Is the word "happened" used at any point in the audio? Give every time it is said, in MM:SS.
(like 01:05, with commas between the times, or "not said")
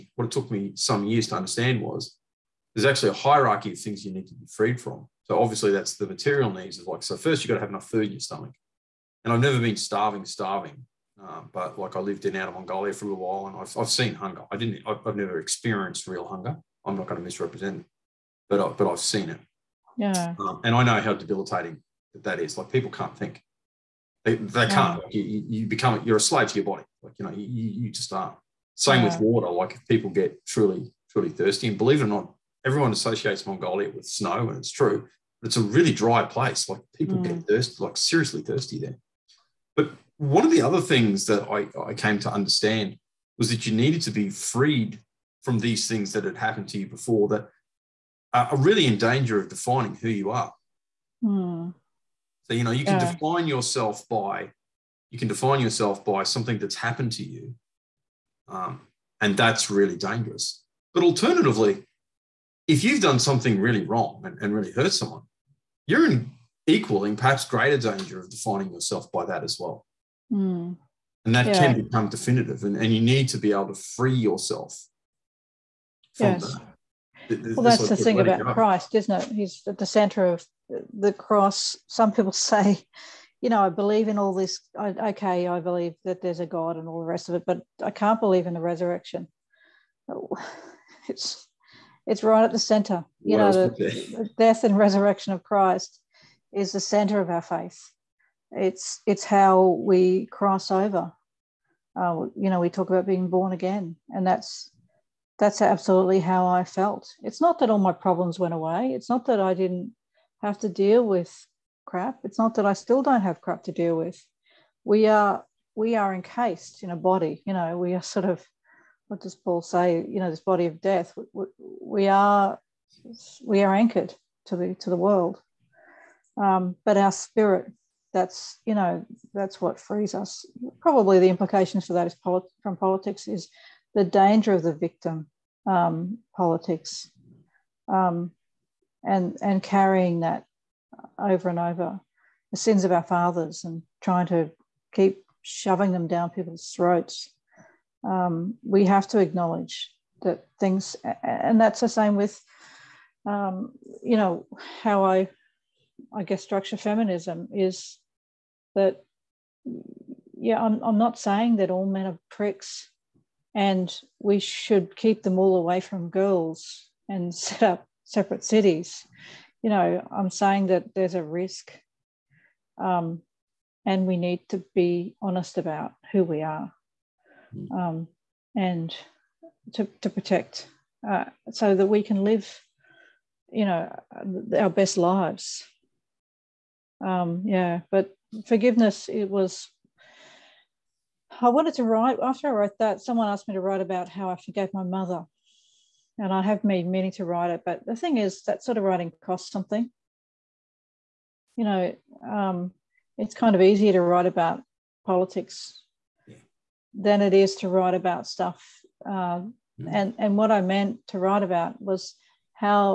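00:46, 00:56.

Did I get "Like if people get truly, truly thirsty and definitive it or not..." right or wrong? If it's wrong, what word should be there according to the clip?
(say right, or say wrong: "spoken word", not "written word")
wrong: "believe", not "definitive".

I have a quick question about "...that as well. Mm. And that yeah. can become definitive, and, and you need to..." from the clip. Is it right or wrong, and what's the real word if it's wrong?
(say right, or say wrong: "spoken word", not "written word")
right.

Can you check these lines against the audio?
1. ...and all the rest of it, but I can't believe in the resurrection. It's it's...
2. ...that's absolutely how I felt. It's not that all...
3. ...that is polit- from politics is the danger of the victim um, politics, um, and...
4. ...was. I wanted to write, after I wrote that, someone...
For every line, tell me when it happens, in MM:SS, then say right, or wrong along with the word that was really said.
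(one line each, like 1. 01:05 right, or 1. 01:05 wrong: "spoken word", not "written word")
1. 01:26 right
2. 01:45 right
3. 02:11 right
4. 03:09 right.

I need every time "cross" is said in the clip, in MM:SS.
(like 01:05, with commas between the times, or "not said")
01:21, 01:40.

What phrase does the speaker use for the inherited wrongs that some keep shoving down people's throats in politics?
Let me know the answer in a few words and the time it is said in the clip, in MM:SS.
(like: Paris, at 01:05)
the sins of our fathers, at 02:22.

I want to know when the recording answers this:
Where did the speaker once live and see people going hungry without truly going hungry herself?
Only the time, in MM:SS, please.
00:12.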